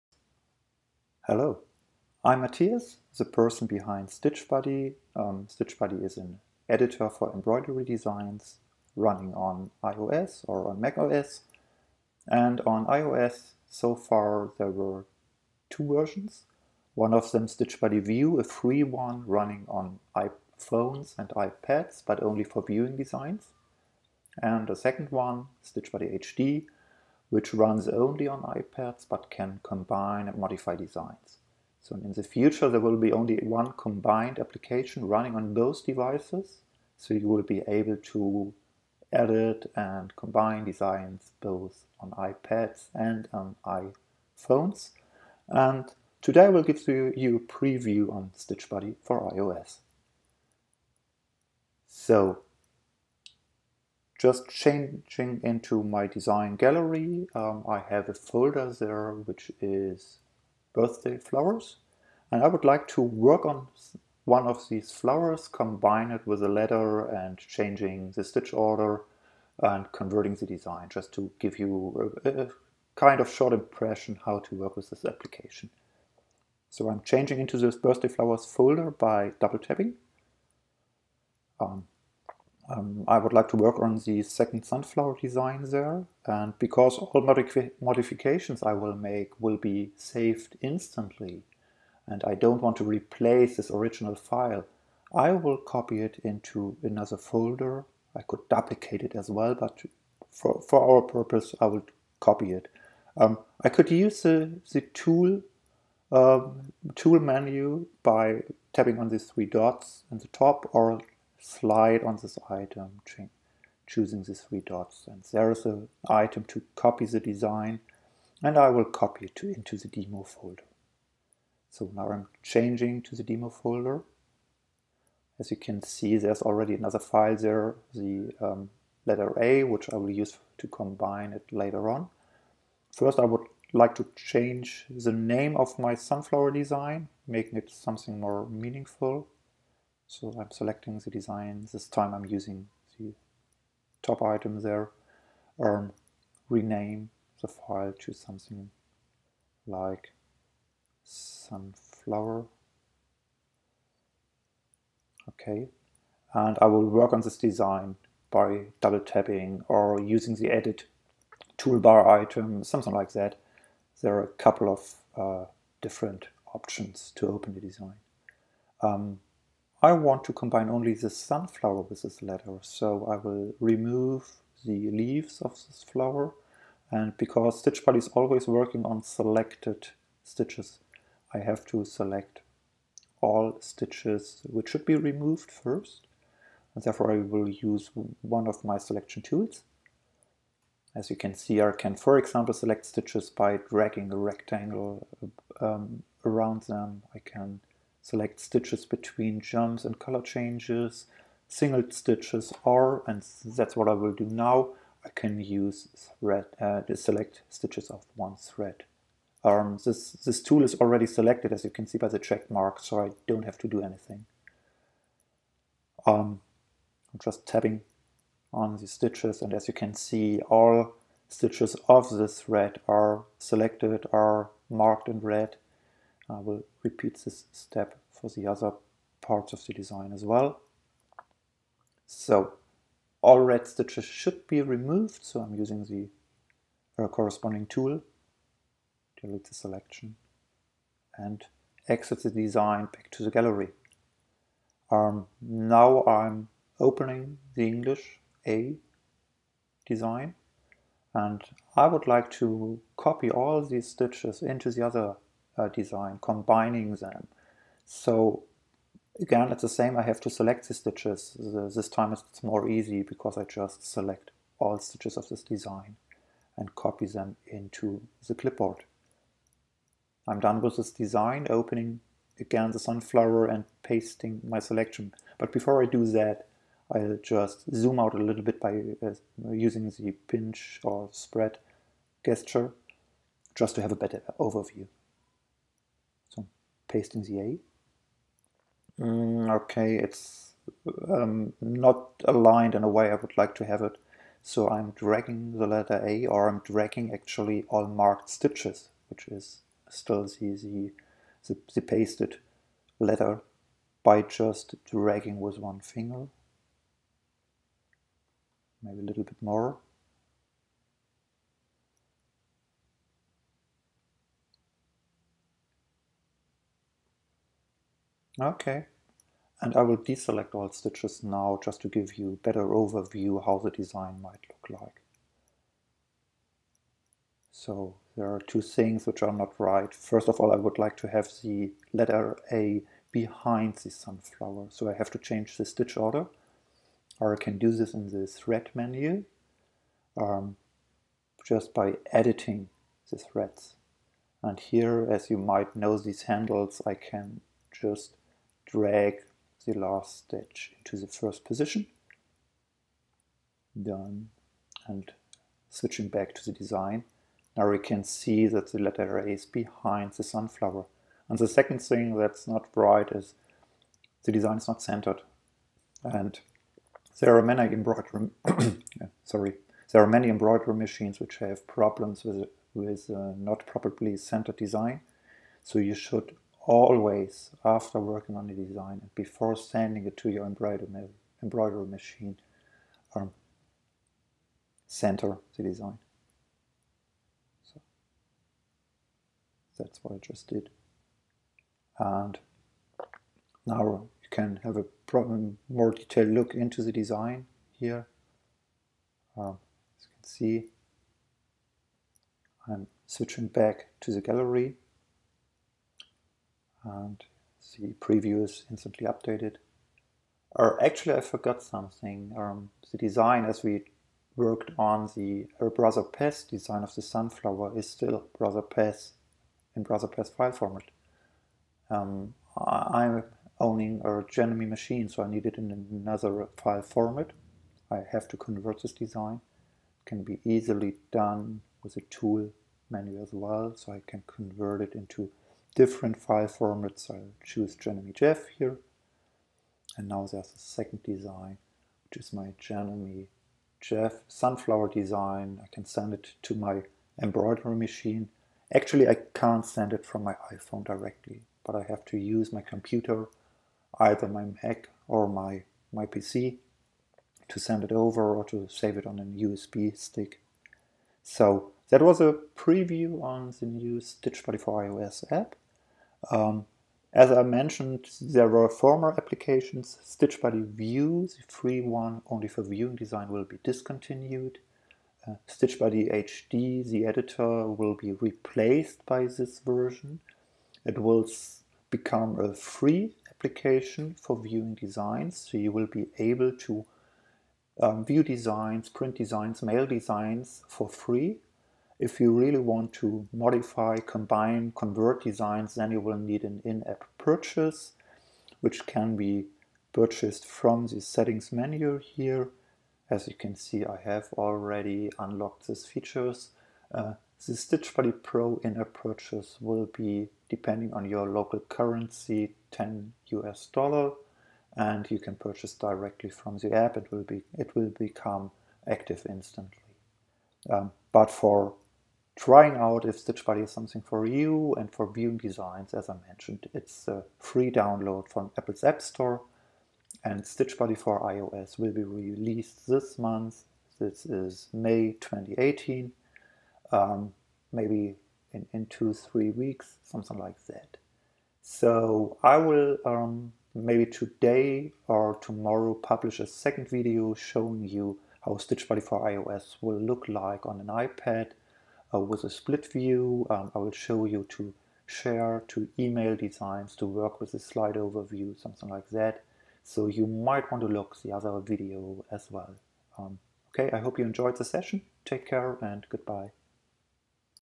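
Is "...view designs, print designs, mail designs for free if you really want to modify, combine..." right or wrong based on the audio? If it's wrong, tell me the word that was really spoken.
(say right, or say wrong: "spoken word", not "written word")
right.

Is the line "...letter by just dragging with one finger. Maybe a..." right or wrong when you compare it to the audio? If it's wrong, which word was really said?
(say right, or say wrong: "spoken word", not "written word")
right.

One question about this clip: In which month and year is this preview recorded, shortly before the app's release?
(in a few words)
May 2018.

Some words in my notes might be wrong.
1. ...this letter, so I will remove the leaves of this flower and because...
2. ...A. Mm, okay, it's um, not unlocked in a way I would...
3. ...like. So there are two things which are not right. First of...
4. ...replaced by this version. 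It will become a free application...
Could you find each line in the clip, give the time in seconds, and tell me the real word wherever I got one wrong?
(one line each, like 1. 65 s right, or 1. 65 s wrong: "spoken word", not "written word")
1. 172 s right
2. 287 s wrong: "aligned", not "unlocked"
3. 324 s right
4. 478 s right.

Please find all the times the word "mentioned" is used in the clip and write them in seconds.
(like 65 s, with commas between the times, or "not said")
467 s, 526 s.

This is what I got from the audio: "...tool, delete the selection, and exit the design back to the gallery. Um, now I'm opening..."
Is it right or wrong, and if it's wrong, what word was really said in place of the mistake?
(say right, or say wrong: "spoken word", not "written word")
right.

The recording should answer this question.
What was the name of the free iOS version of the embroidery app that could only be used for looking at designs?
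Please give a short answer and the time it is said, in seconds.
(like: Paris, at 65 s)
Stitch Buddy View, at 17 s.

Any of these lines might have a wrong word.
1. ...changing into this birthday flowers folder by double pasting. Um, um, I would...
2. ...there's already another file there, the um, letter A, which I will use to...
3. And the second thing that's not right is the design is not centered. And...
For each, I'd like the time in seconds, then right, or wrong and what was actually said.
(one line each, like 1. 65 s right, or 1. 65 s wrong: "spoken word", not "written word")
1. 77 s wrong: "tapping", not "pasting"
2. 126 s right
3. 361 s right.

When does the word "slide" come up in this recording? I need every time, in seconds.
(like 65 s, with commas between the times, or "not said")
111 s, 557 s.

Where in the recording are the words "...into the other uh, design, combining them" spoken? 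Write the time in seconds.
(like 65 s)
254 s.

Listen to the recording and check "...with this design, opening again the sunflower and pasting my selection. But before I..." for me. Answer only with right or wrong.
right.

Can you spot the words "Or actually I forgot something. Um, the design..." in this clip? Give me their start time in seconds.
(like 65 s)
410 s.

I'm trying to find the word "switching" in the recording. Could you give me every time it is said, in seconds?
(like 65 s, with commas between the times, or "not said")
355 s, 403 s.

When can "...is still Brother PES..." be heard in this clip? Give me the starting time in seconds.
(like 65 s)
417 s.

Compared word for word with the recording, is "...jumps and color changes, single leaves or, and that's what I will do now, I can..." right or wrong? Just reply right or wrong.
wrong.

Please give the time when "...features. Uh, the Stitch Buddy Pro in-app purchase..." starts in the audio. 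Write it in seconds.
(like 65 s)
505 s.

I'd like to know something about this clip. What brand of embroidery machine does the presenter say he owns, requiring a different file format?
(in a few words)
Janome.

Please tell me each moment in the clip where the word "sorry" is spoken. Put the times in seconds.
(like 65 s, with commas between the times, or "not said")
369 s.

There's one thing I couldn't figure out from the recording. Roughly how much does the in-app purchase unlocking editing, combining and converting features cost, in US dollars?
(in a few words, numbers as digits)
10.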